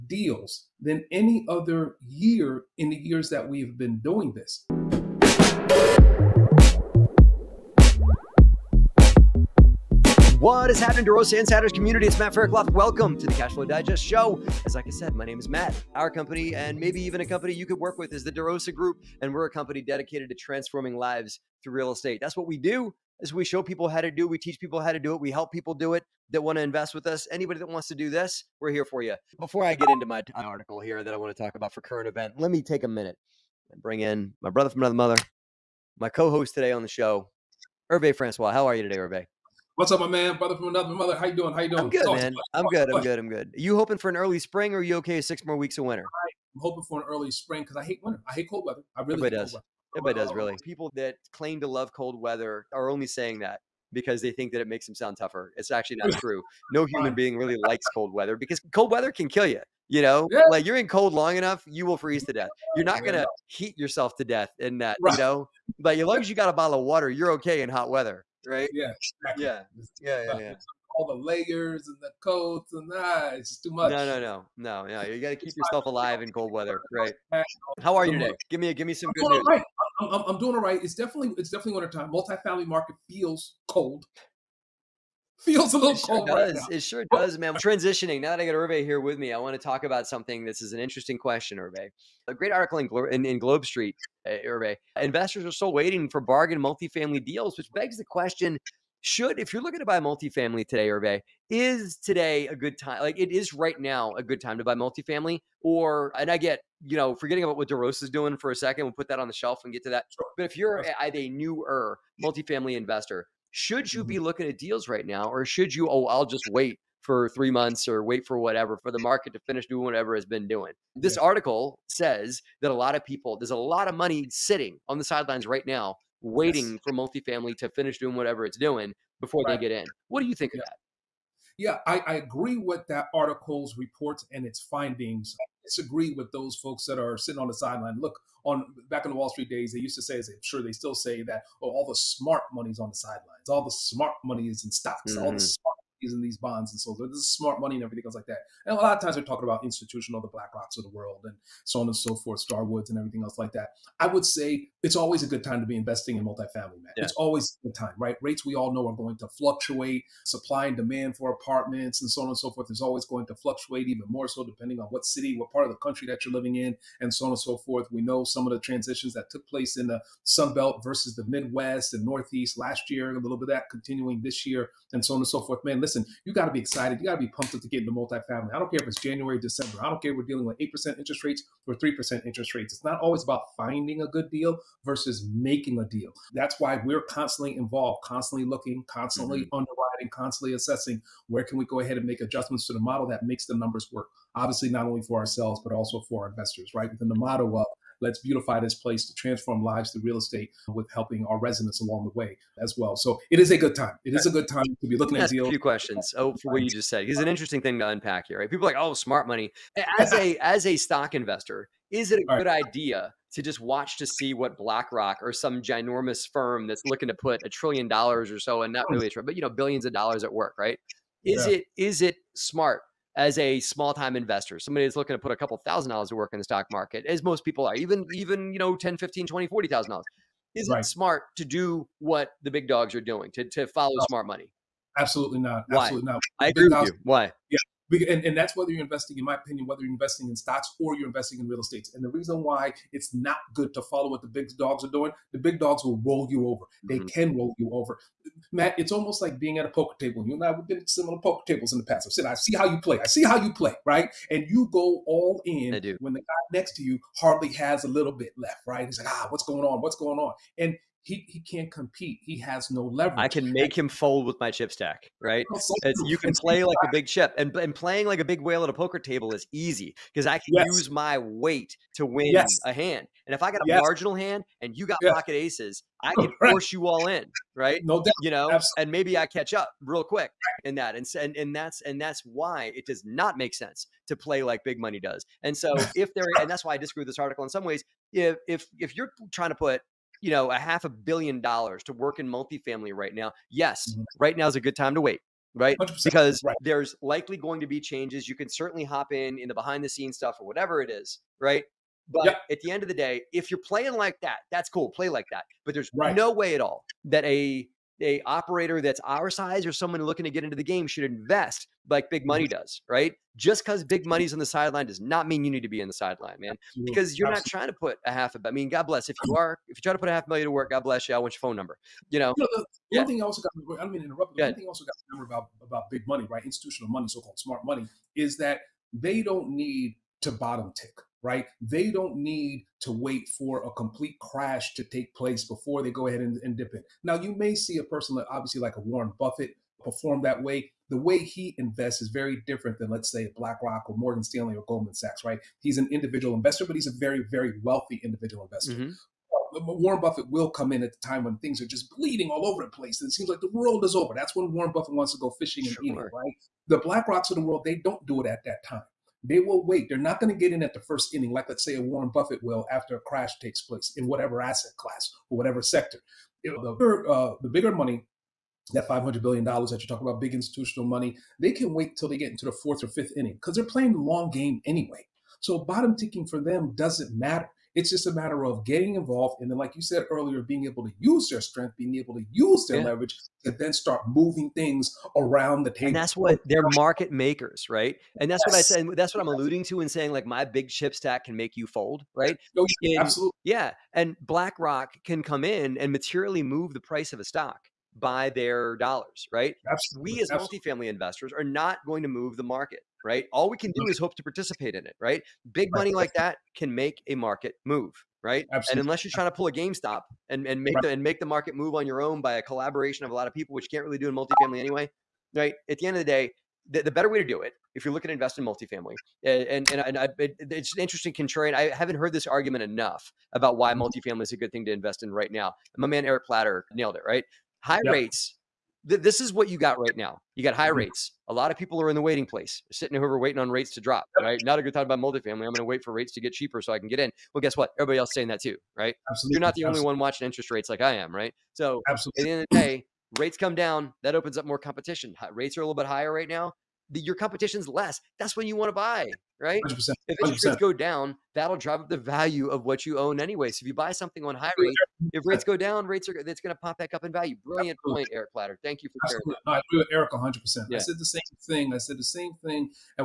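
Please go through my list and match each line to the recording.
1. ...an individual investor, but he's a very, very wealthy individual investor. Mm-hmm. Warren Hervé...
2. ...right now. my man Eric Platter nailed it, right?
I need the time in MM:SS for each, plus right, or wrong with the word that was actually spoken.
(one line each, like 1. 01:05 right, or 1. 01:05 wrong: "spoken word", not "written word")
1. 05:45 wrong: "Buffett", not "Hervé"
2. 07:05 right.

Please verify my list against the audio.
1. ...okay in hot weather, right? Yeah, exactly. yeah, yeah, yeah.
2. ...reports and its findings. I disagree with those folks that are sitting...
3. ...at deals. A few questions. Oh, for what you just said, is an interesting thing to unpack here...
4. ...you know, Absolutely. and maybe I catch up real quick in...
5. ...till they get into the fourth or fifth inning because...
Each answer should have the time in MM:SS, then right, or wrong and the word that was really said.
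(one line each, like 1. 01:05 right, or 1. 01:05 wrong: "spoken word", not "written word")
1. 01:07 right
2. 02:13 right
3. 03:25 right
4. 04:38 right
5. 06:11 right.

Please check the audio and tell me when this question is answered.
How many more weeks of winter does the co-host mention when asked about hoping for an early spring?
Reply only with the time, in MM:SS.
00:45.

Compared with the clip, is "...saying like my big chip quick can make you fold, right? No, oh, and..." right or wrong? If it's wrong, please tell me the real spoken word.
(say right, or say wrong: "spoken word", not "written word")
wrong: "stack", not "quick".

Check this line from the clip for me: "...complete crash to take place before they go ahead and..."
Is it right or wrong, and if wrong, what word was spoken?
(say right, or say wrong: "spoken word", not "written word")
right.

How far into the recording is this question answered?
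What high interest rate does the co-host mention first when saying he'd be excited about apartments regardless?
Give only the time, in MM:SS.
03:00.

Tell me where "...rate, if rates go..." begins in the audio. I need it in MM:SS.
07:34.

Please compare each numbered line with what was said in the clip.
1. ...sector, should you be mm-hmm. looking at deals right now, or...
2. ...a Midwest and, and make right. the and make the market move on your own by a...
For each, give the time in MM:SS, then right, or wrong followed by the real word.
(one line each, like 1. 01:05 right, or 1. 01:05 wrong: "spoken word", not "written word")
1. 01:52 wrong: "investor", not "sector"
2. 06:49 wrong: "GameStop", not "Midwest".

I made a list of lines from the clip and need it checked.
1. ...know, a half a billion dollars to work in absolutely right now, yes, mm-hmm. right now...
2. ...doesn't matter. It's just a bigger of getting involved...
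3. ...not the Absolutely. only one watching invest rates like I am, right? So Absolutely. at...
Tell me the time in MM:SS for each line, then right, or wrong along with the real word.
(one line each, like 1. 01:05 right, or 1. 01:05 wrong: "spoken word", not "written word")
1. 04:50 wrong: "multifamily", not "absolutely"
2. 06:16 wrong: "matter", not "bigger"
3. 07:19 wrong: "interest", not "invest".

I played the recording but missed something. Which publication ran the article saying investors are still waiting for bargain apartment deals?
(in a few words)
Globe Street.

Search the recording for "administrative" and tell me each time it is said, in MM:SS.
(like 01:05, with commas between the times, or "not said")
not said.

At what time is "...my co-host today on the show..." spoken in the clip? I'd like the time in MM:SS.
00:35.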